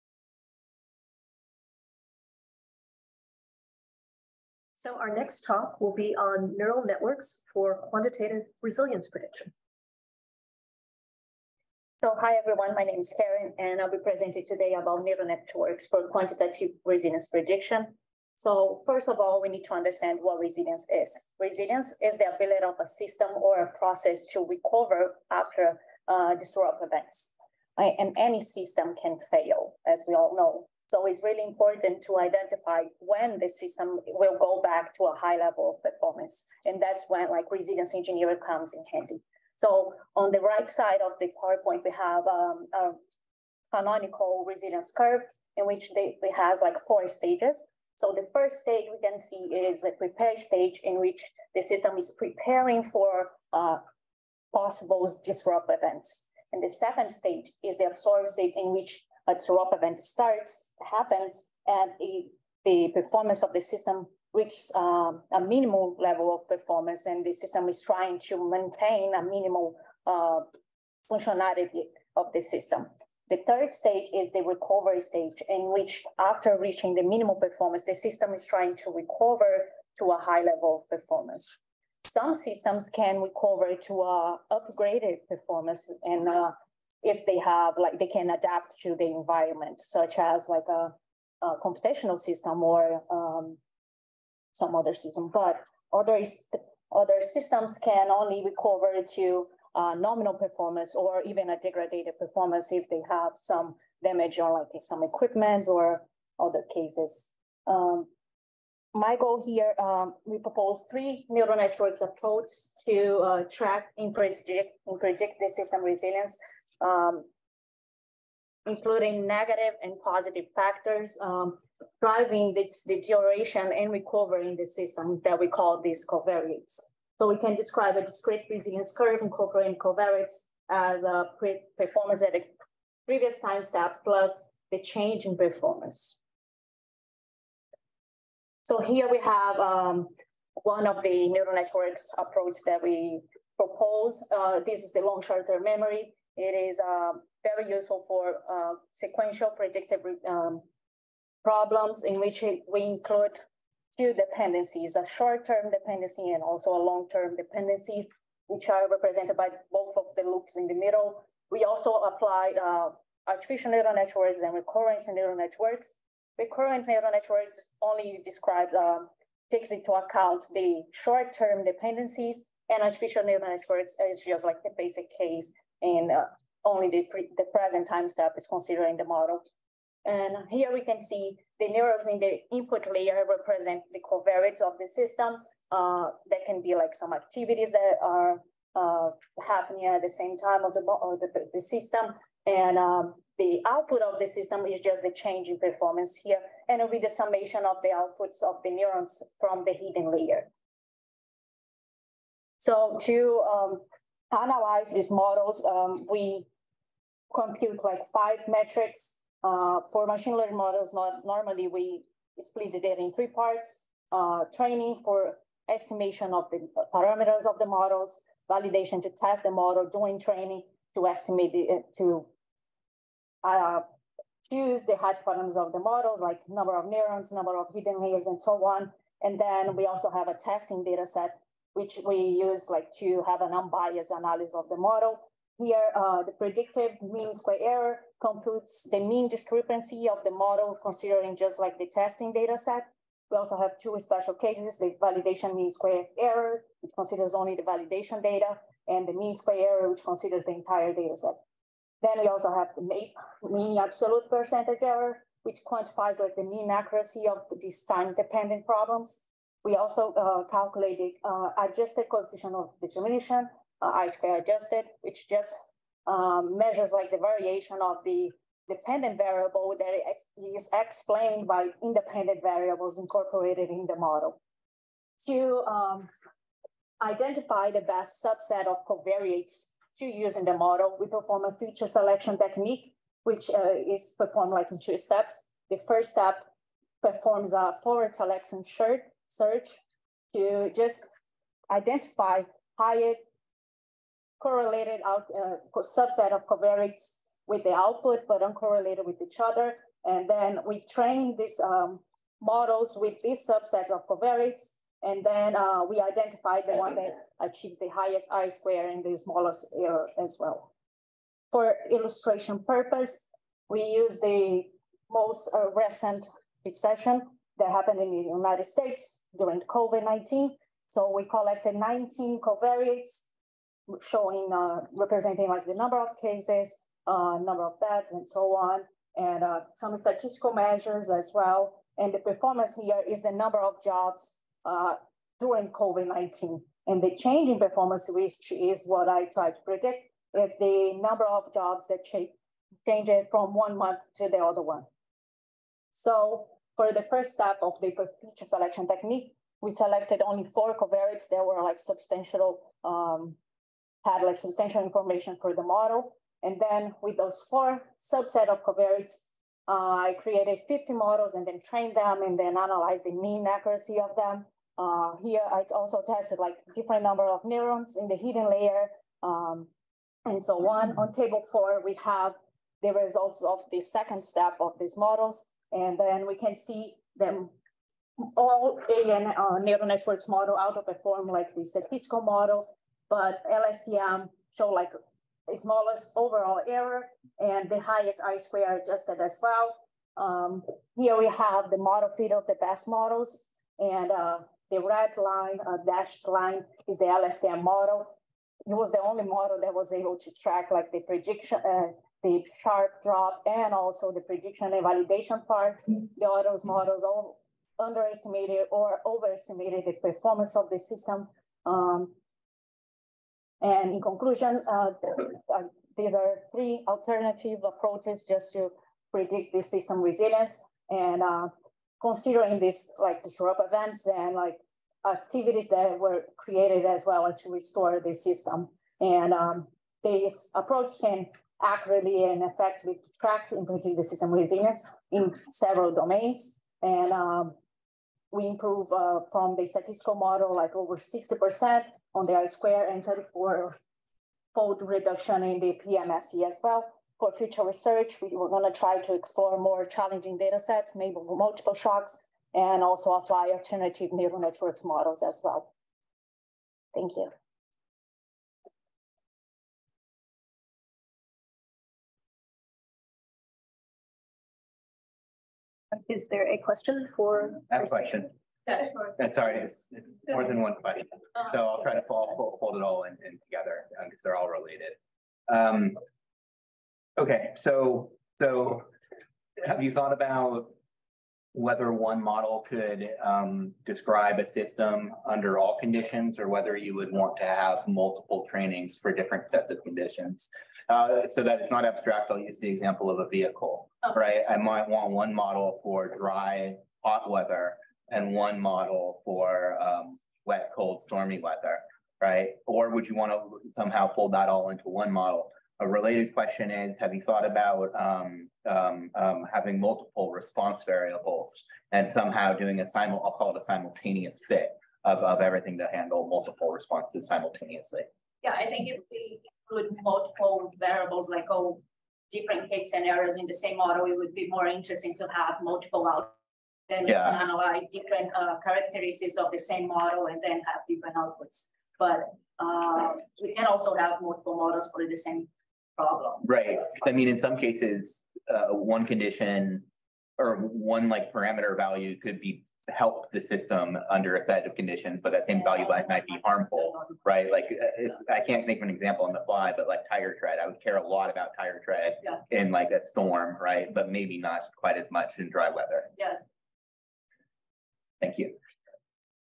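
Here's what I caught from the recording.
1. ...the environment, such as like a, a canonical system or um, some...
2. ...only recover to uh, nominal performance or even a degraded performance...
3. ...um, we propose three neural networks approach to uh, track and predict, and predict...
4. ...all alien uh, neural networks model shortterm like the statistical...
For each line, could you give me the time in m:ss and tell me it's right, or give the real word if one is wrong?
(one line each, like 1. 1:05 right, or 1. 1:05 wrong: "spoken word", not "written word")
1. 1:28 wrong: "computational", not "canonical"
2. 1:38 right
3. 1:49 right
4. 6:18 wrong: "outperform", not "shortterm".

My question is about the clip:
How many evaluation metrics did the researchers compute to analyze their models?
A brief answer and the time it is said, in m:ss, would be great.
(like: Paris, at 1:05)
5, at 3:28.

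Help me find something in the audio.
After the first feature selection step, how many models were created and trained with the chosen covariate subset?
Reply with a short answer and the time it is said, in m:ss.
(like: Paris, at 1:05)
50, at 6:00.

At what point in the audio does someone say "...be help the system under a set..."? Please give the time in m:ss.
9:02.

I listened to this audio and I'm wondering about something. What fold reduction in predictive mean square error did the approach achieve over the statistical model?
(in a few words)
34-fold.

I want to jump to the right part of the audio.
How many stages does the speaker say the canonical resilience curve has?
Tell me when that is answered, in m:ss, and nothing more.
0:46.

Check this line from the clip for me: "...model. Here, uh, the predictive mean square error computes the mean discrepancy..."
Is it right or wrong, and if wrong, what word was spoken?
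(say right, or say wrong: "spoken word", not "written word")
right.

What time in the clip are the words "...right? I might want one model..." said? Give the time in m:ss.
8:14.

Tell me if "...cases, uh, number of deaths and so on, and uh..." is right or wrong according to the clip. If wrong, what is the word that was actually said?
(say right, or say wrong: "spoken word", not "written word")
right.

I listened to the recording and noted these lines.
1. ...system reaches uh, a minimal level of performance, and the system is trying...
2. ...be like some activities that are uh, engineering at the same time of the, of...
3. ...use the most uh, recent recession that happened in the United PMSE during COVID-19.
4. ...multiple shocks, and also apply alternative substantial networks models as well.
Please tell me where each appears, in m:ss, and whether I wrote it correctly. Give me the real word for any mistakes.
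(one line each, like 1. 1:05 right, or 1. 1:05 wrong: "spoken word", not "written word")
1. 1:03 right
2. 3:06 wrong: "happening", not "engineering"
3. 5:13 wrong: "States", not "PMSE"
4. 7:31 wrong: "neural", not "substantial".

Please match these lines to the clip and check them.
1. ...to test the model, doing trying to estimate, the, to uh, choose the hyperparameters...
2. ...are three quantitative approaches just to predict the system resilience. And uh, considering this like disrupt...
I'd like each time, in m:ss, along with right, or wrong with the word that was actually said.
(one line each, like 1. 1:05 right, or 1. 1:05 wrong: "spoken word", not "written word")
1. 3:39 wrong: "training", not "trying"
2. 6:56 wrong: "alternative", not "quantitative".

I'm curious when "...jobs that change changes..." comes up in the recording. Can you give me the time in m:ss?
5:41.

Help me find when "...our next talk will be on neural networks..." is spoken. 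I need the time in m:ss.
0:04.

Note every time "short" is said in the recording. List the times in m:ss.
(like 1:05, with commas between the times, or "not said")
2:25, 2:35, 2:50.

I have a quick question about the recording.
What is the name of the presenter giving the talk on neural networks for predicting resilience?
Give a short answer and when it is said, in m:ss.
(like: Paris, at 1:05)
Karen, at 0:13.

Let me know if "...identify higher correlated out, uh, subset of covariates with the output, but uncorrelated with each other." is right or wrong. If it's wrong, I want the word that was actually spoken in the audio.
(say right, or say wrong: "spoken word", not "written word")
right.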